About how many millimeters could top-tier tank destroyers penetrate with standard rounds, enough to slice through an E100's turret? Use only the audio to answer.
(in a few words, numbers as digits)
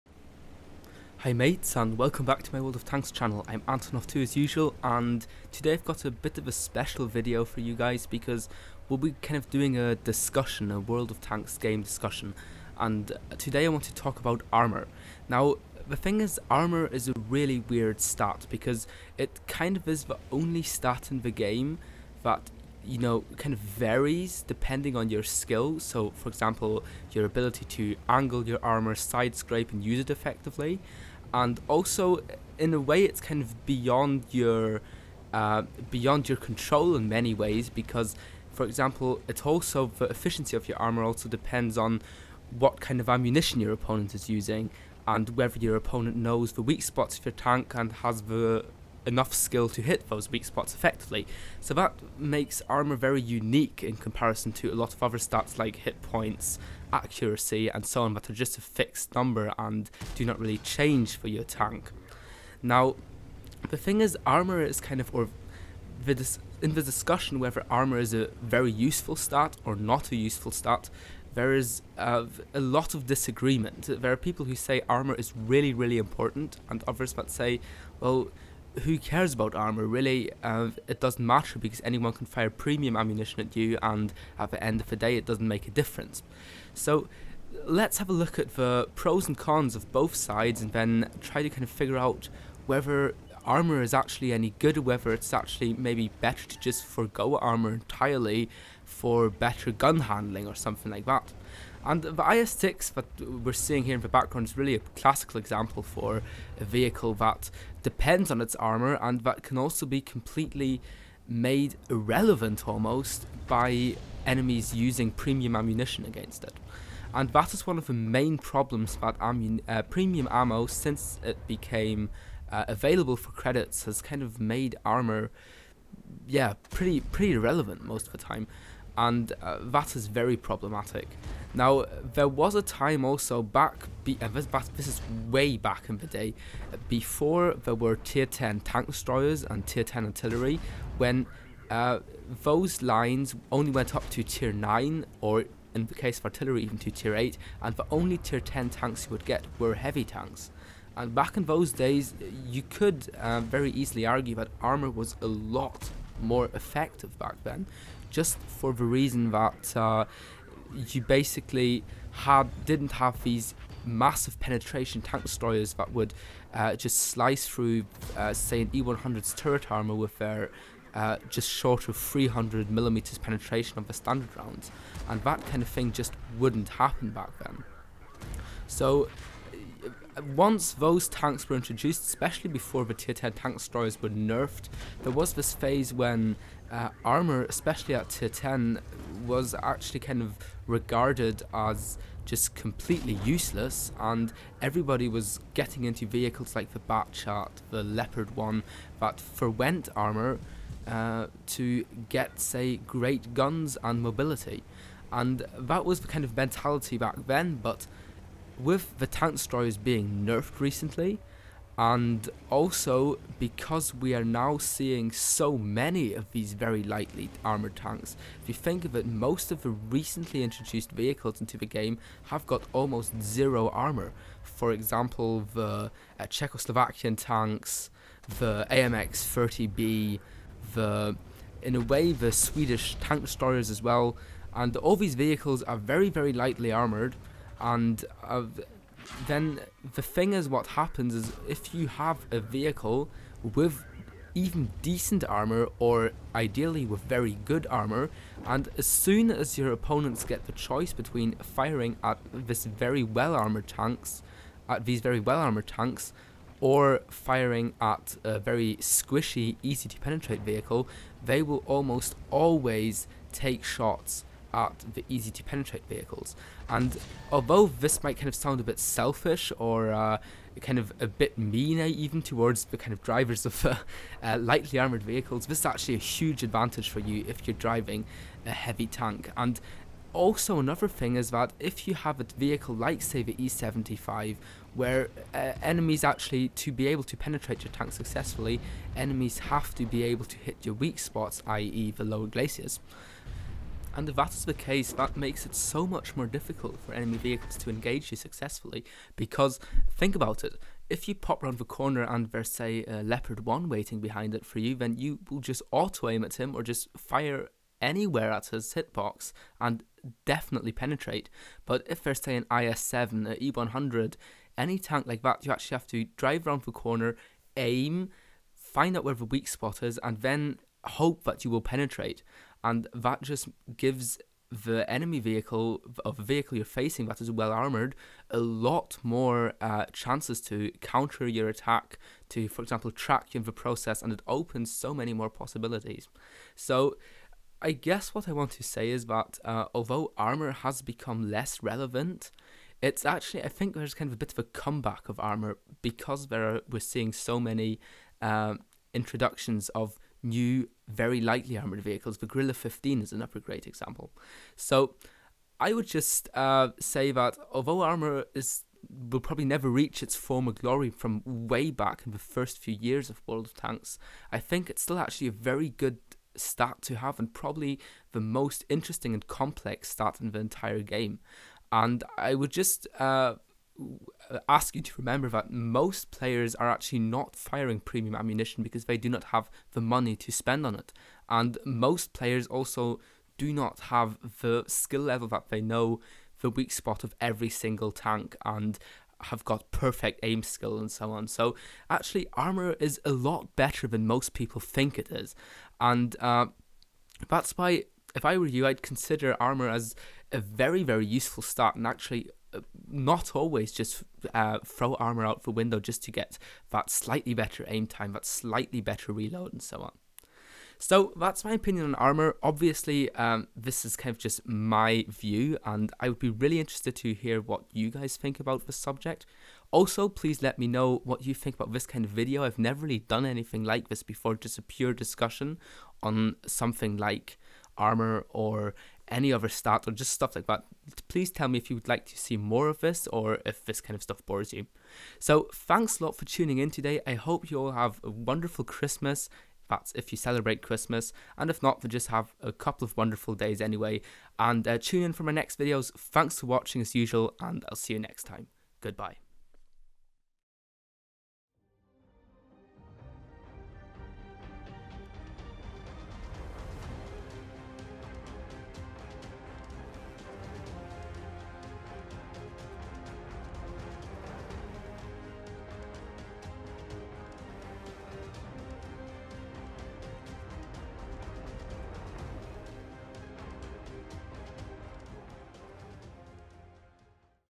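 300 millimeters.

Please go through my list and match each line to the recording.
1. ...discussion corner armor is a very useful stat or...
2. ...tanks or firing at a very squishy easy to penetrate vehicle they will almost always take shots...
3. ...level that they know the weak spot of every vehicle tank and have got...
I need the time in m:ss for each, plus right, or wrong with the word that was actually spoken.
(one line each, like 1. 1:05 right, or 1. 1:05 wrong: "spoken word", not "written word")
1. 1:06 wrong: "whether", not "corner"
2. 4:15 right
3. 6:25 wrong: "single", not "vehicle".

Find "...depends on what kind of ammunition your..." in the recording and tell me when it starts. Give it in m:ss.
0:41.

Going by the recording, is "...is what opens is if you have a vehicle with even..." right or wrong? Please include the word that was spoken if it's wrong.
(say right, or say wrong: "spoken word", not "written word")
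wrong: "happens", not "opens".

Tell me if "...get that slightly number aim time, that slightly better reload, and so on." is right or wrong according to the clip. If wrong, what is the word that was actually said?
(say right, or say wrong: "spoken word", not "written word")
wrong: "better", not "number".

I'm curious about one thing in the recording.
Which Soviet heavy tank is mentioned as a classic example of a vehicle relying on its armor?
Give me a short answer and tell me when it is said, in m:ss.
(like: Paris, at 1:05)
IS6, at 1:42.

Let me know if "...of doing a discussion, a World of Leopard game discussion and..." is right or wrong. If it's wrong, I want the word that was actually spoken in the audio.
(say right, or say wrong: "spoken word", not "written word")
wrong: "Tanks", not "Leopard".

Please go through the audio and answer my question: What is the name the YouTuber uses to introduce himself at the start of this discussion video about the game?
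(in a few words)
Antonow2.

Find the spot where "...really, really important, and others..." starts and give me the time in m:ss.
1:15.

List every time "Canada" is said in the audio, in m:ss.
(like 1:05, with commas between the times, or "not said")
not said.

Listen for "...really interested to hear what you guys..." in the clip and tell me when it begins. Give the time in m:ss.
6:56.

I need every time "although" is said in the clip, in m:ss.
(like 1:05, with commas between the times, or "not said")
4:27, 5:39, 5:57.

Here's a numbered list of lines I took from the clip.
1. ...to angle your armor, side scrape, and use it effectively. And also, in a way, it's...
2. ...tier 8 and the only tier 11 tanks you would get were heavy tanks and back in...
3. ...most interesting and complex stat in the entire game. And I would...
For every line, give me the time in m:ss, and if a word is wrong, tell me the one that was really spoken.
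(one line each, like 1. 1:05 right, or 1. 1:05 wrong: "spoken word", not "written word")
1. 0:27 right
2. 2:26 wrong: "10", not "11"
3. 6:08 right.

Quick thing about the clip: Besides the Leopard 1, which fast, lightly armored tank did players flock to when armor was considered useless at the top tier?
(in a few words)
Batchat.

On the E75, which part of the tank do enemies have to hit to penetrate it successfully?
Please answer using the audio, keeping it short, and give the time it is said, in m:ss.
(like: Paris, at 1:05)
lower glaciers, at 4:52.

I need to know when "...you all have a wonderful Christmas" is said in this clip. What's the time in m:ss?
7:17.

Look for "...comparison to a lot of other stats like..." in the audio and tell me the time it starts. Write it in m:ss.
0:53.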